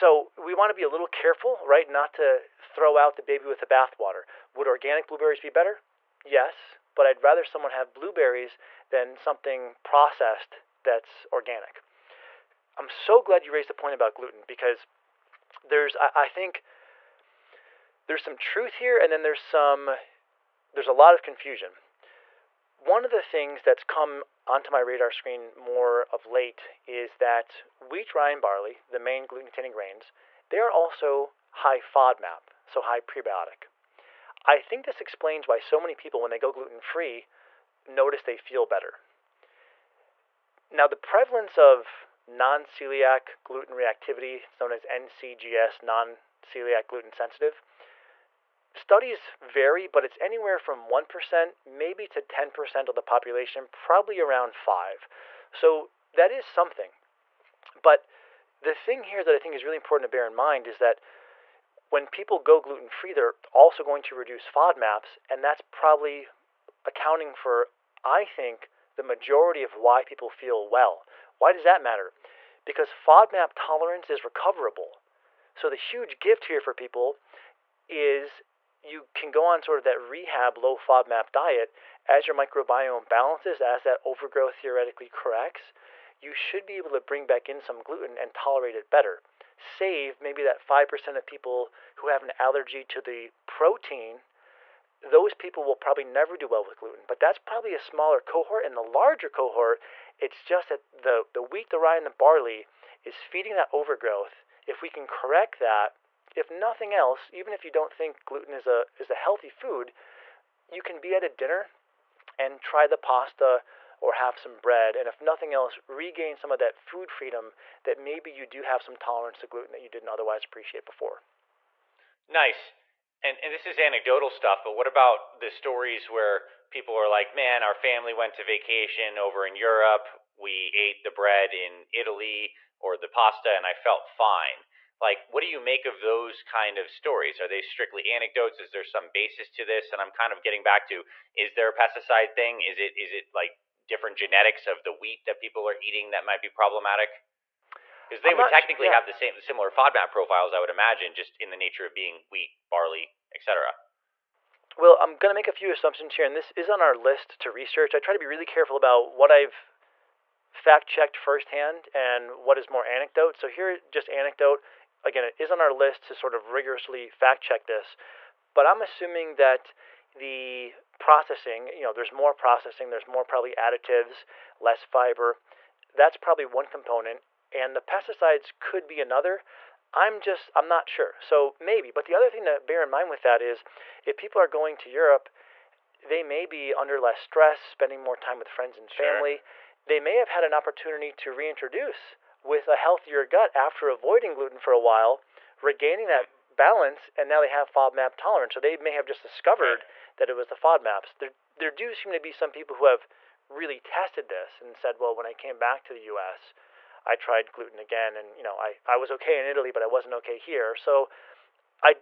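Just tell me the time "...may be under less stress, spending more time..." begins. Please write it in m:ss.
3:06.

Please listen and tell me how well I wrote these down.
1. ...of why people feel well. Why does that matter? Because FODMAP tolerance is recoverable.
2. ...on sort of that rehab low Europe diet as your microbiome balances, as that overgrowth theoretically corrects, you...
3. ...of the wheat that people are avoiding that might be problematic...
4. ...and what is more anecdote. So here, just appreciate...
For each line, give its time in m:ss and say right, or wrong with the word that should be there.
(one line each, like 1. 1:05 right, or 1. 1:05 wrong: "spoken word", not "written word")
1. 1:09 right
2. 1:19 wrong: "FODMAP", not "Europe"
3. 2:24 wrong: "eating", not "avoiding"
4. 2:41 wrong: "anecdote", not "appreciate".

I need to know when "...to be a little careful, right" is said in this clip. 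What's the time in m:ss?
0:00.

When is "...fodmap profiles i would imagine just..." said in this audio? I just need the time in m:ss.
2:29.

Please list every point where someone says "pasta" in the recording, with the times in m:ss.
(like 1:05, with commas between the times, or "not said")
1:52, 2:13.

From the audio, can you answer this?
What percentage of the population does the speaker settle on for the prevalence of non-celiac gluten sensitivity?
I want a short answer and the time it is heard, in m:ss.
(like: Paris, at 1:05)
5%, at 0:53.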